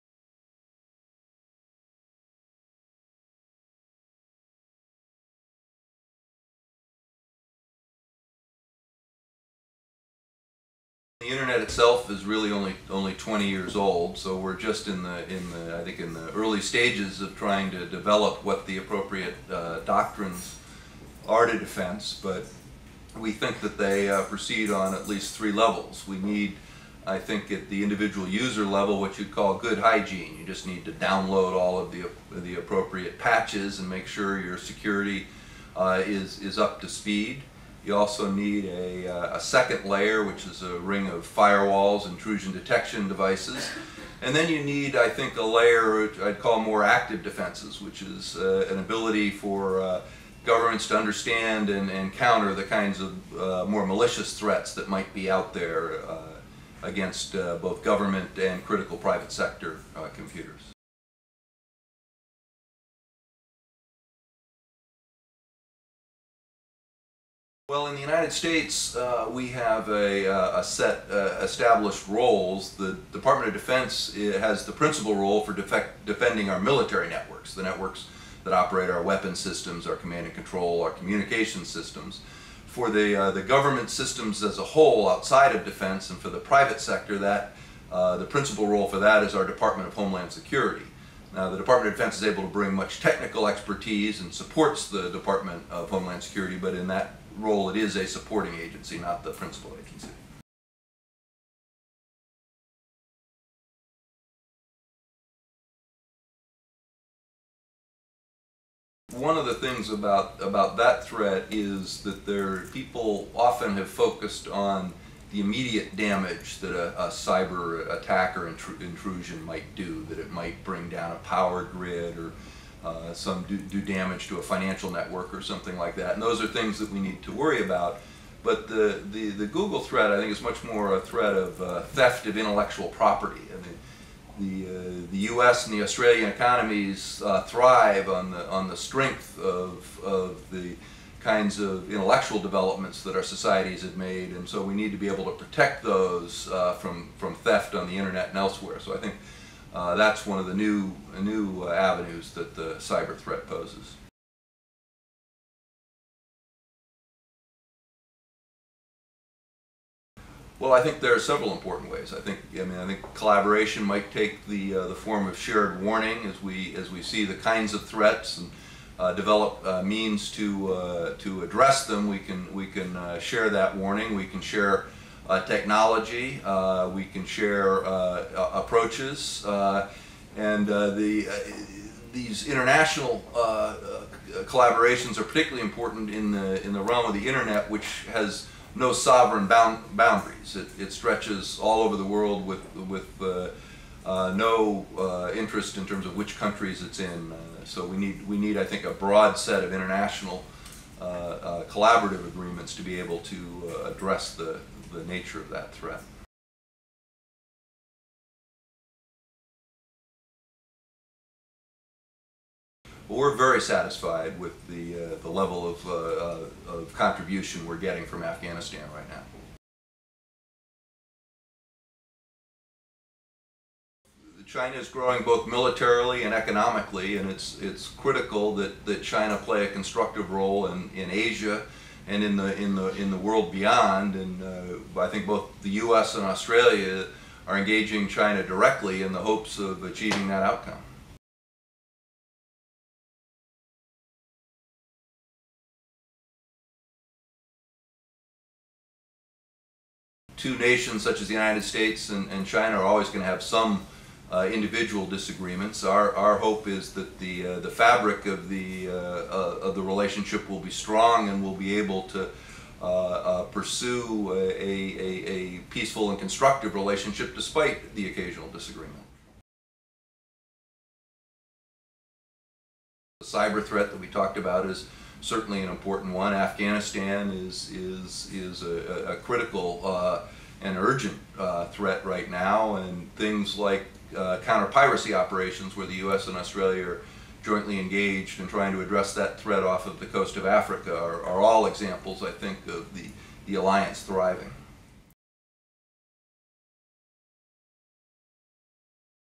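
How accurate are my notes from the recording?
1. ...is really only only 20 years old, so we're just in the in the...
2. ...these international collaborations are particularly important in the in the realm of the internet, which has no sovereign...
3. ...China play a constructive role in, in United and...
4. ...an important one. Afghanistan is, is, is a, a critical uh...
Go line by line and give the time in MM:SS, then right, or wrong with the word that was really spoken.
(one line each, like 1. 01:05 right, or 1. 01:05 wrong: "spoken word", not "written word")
1. 00:12 right
2. 03:02 right
3. 03:49 wrong: "Asia", not "United"
4. 04:35 right.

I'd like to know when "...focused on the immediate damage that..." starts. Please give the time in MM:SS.
01:53.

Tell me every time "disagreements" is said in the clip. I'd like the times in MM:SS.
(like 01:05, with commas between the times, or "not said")
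04:15, 04:28.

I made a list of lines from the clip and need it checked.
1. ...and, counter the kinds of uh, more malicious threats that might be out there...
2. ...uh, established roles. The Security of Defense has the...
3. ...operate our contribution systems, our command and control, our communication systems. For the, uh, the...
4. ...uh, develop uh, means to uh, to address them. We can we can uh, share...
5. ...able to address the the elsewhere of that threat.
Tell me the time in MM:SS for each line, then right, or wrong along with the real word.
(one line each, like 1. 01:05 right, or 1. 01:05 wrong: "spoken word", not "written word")
1. 00:51 right
2. 01:11 wrong: "Department", not "Security"
3. 01:18 wrong: "weapon", not "contribution"
4. 02:48 right
5. 03:22 wrong: "nature", not "elsewhere".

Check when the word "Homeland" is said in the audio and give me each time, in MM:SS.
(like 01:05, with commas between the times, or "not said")
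01:29, 01:35.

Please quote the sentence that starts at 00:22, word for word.
But we think that they uh, proceed on at least three levels.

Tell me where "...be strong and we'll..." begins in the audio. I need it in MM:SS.
04:20.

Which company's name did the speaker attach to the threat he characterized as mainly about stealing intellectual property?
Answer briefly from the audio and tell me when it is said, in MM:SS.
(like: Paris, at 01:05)
Google, at 02:09.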